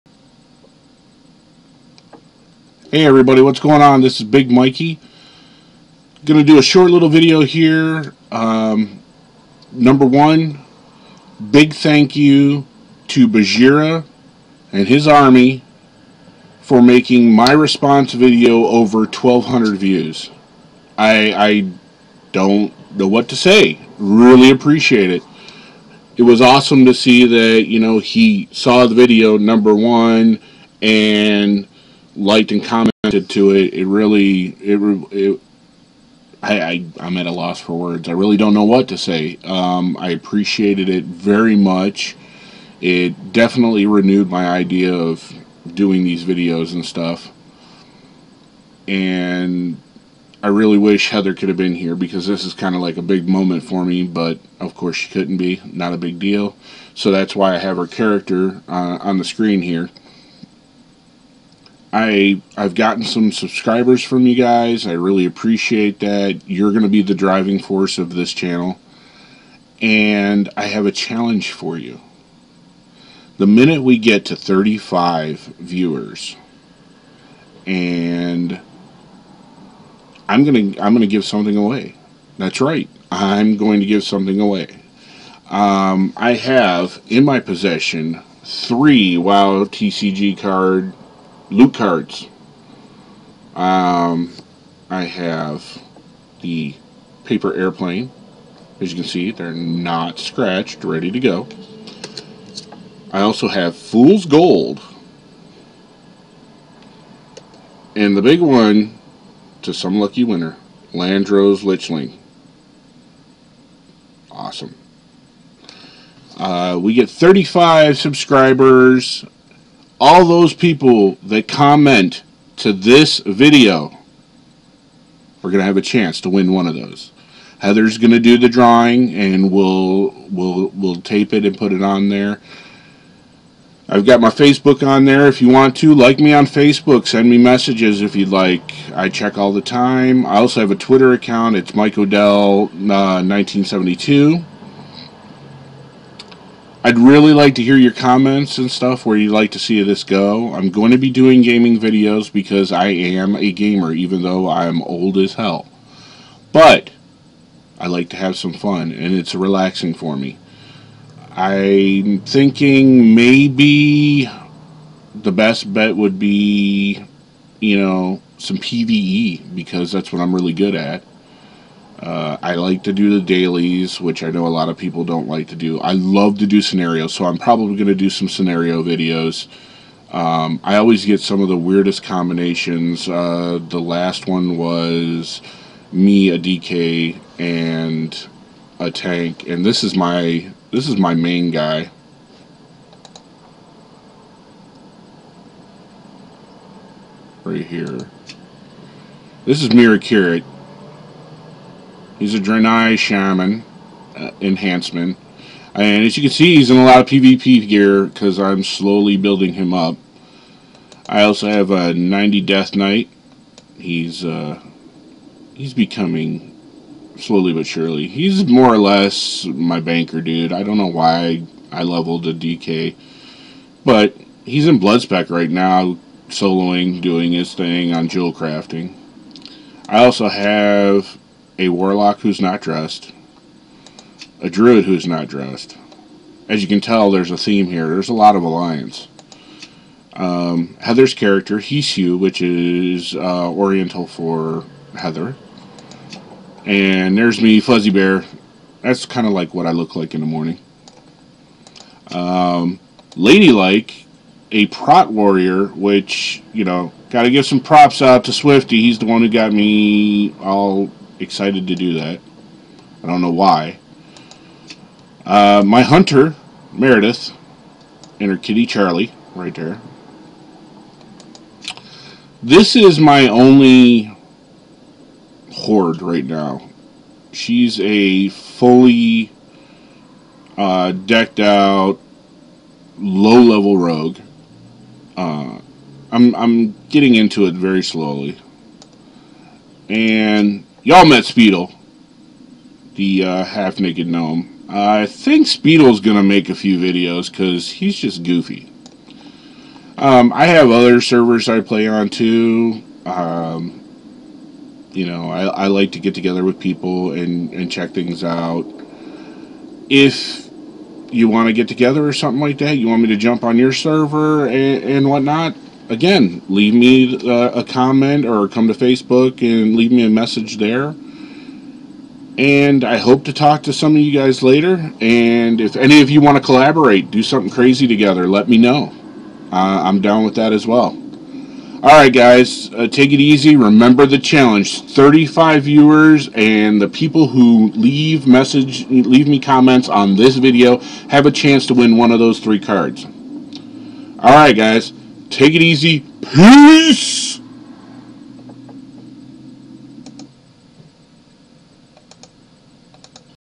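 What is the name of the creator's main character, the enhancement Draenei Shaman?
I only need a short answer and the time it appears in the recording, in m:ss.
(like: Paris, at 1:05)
Mirakirith, at 3:19.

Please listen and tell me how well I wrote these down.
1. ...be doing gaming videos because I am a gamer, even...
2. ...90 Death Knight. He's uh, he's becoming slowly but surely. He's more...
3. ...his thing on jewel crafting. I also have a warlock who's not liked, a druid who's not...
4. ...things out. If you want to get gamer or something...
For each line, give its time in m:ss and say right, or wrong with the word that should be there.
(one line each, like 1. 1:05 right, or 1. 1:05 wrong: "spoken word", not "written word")
1. 2:30 right
2. 3:31 right
3. 3:47 wrong: "dressed", not "liked"
4. 5:07 wrong: "together", not "gamer".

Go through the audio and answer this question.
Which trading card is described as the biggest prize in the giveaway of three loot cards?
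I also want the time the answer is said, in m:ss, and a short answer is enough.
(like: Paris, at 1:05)
Landro's Lichling, at 1:50.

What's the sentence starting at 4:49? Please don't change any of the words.
And Y'all met Speedle, the uh, half-naked gnome.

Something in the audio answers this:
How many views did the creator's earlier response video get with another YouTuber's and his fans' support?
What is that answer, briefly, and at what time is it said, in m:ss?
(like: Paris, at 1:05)
over 1,200, at 0:18.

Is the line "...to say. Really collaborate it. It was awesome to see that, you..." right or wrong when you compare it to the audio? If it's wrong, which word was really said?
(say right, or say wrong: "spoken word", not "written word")
wrong: "appreciate", not "collaborate".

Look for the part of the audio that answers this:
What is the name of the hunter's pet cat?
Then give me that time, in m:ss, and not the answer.
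4:28.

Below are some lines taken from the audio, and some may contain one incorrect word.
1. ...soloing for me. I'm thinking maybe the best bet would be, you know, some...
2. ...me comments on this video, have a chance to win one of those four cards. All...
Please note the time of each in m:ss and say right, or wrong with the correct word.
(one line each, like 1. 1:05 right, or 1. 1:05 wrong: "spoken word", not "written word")
1. 2:39 wrong: "relaxing", not "soloing"
2. 5:39 wrong: "three", not "four".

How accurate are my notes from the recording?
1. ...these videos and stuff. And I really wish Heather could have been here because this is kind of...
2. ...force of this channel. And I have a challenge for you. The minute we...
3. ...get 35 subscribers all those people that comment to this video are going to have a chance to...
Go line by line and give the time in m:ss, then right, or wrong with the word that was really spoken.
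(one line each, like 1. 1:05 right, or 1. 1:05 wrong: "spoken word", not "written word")
1. 0:46 right
2. 1:07 right
3. 1:56 right.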